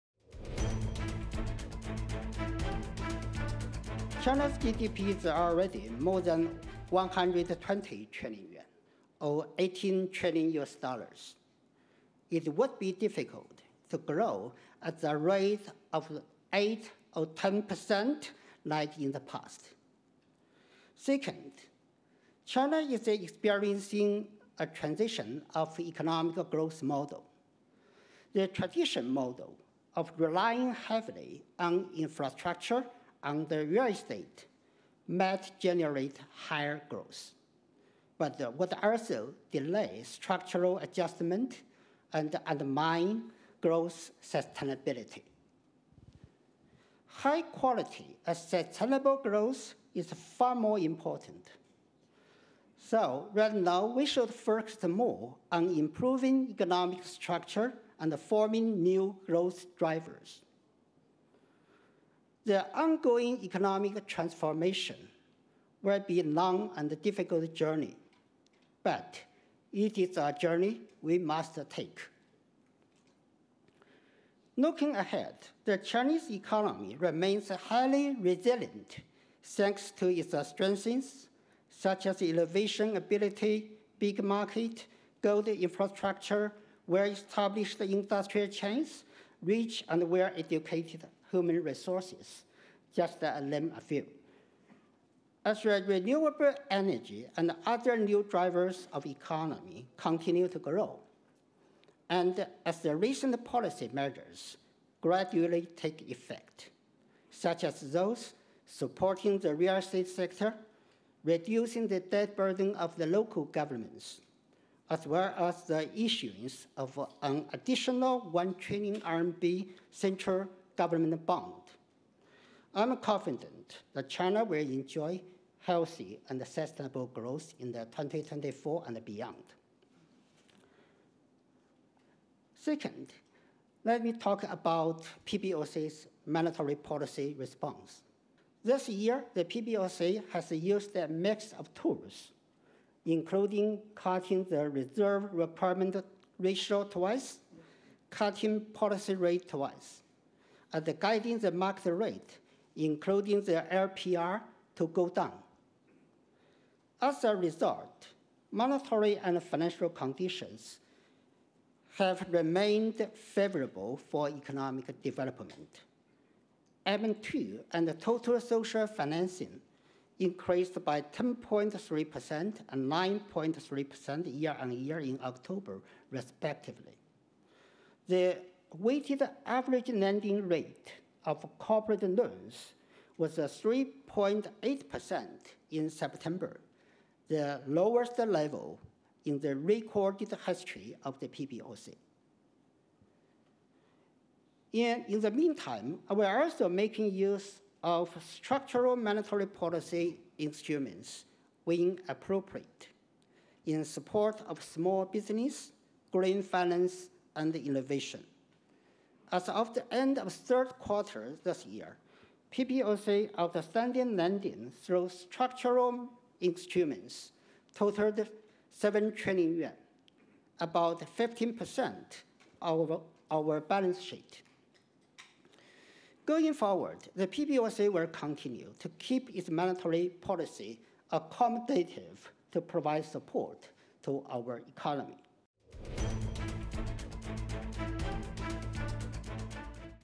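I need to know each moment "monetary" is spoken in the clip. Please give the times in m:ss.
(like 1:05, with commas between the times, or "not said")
2:16, 2:38, 3:18, 3:49.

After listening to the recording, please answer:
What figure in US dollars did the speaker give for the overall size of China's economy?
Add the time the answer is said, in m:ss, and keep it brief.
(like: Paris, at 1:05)
18 trillion US dollars, at 0:09.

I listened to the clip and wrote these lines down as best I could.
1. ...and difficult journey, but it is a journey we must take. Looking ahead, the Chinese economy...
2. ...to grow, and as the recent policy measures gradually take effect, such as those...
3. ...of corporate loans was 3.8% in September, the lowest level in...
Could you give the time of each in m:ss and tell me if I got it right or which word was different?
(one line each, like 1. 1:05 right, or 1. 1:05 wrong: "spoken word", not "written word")
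1. 1:06 right
2. 1:40 right
3. 3:01 right.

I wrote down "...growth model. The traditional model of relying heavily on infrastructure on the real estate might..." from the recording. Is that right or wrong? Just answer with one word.
right.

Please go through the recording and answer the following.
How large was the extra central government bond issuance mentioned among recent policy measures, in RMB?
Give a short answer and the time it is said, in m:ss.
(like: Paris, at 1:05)
1 trillion RMB, at 1:58.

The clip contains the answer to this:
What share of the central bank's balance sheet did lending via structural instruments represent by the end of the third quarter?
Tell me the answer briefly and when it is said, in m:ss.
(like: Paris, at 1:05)
15%, at 3:41.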